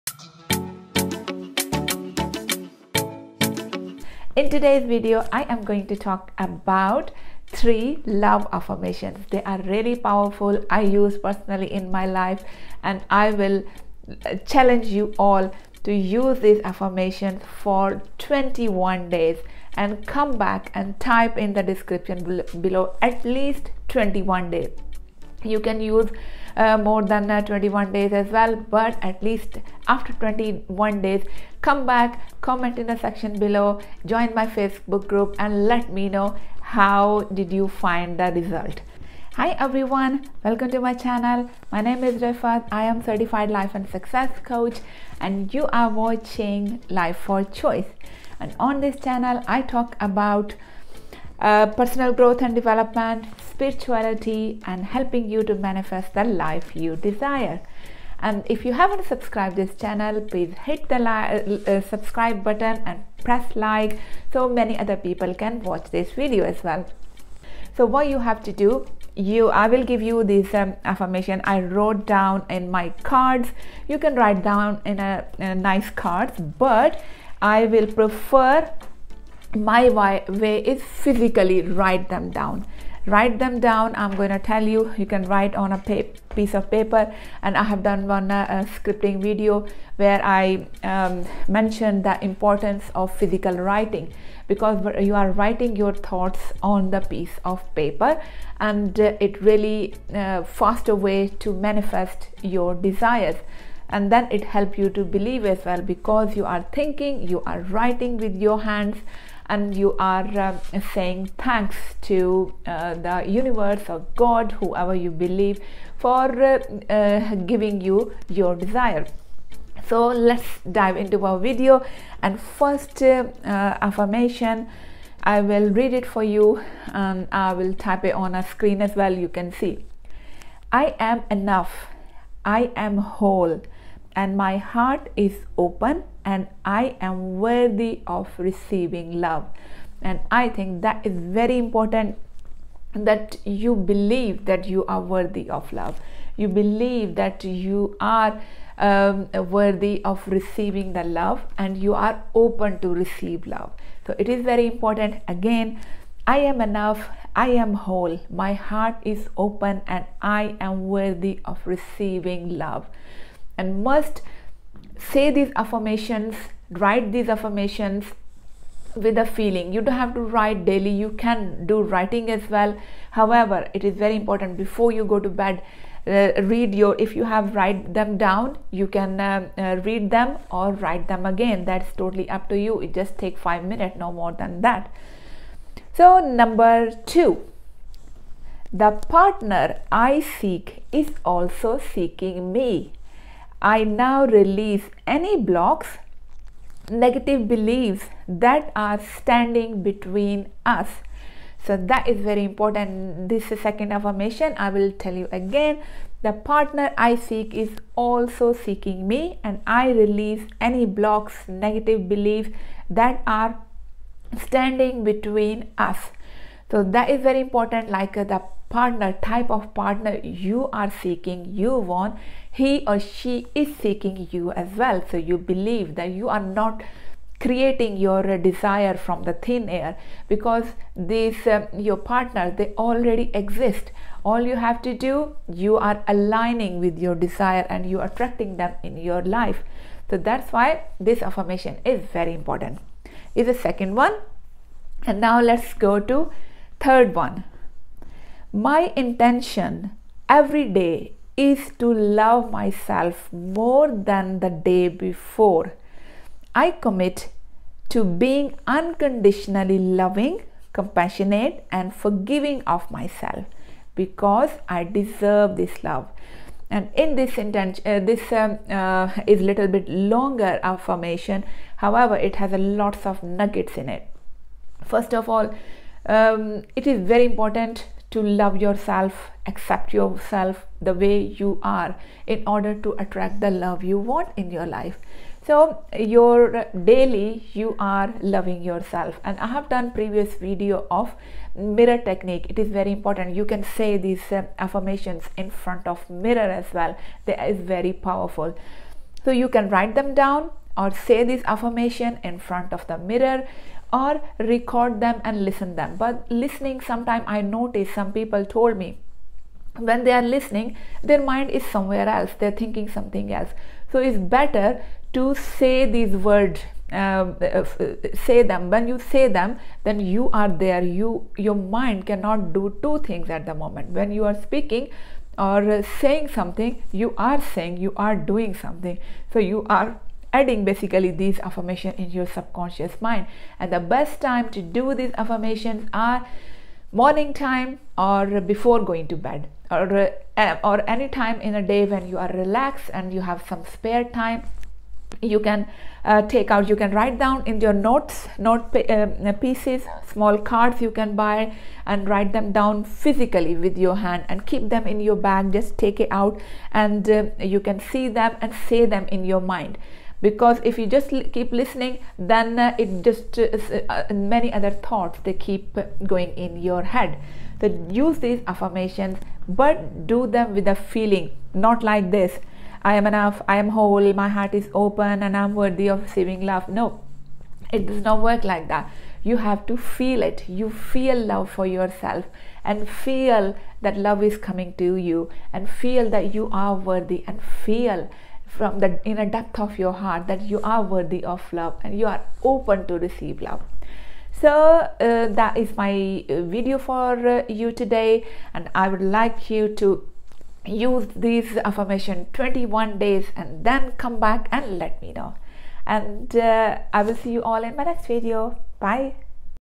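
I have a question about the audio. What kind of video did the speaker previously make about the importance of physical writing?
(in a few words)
Scripting video.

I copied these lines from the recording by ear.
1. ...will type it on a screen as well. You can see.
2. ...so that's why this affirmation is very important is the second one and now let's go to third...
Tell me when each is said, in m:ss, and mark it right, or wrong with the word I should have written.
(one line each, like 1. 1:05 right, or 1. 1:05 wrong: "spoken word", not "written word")
1. 2:07 right
2. 4:00 right.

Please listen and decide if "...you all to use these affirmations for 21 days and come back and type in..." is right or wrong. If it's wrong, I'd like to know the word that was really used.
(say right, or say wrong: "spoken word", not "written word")
right.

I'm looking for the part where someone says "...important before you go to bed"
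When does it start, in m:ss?
2:54.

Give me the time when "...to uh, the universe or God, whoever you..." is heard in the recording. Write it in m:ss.
1:52.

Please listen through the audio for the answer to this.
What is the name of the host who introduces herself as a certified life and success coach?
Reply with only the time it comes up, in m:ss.
0:42.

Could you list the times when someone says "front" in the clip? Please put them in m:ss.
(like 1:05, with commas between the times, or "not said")
4:55, 5:02.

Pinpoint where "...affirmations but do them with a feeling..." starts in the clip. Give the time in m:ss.
6:08.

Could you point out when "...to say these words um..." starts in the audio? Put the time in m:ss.
5:15.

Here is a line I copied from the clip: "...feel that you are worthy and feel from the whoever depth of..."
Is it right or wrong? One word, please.
wrong.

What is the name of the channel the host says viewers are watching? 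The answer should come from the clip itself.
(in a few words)
Life for Choice.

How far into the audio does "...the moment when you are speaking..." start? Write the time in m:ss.
5:23.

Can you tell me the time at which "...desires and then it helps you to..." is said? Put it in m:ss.
1:42.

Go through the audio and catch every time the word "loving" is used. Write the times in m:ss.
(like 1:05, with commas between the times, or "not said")
4:19, 4:48.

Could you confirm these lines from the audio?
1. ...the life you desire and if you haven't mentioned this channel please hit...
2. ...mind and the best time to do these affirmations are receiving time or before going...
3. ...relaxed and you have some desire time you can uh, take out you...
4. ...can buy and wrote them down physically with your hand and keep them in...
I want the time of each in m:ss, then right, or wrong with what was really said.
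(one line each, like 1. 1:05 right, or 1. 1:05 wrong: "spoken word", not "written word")
1. 0:56 wrong: "subscribed", not "mentioned"
2. 5:33 wrong: "morning", not "receiving"
3. 5:42 wrong: "spare", not "desire"
4. 5:50 wrong: "write", not "wrote".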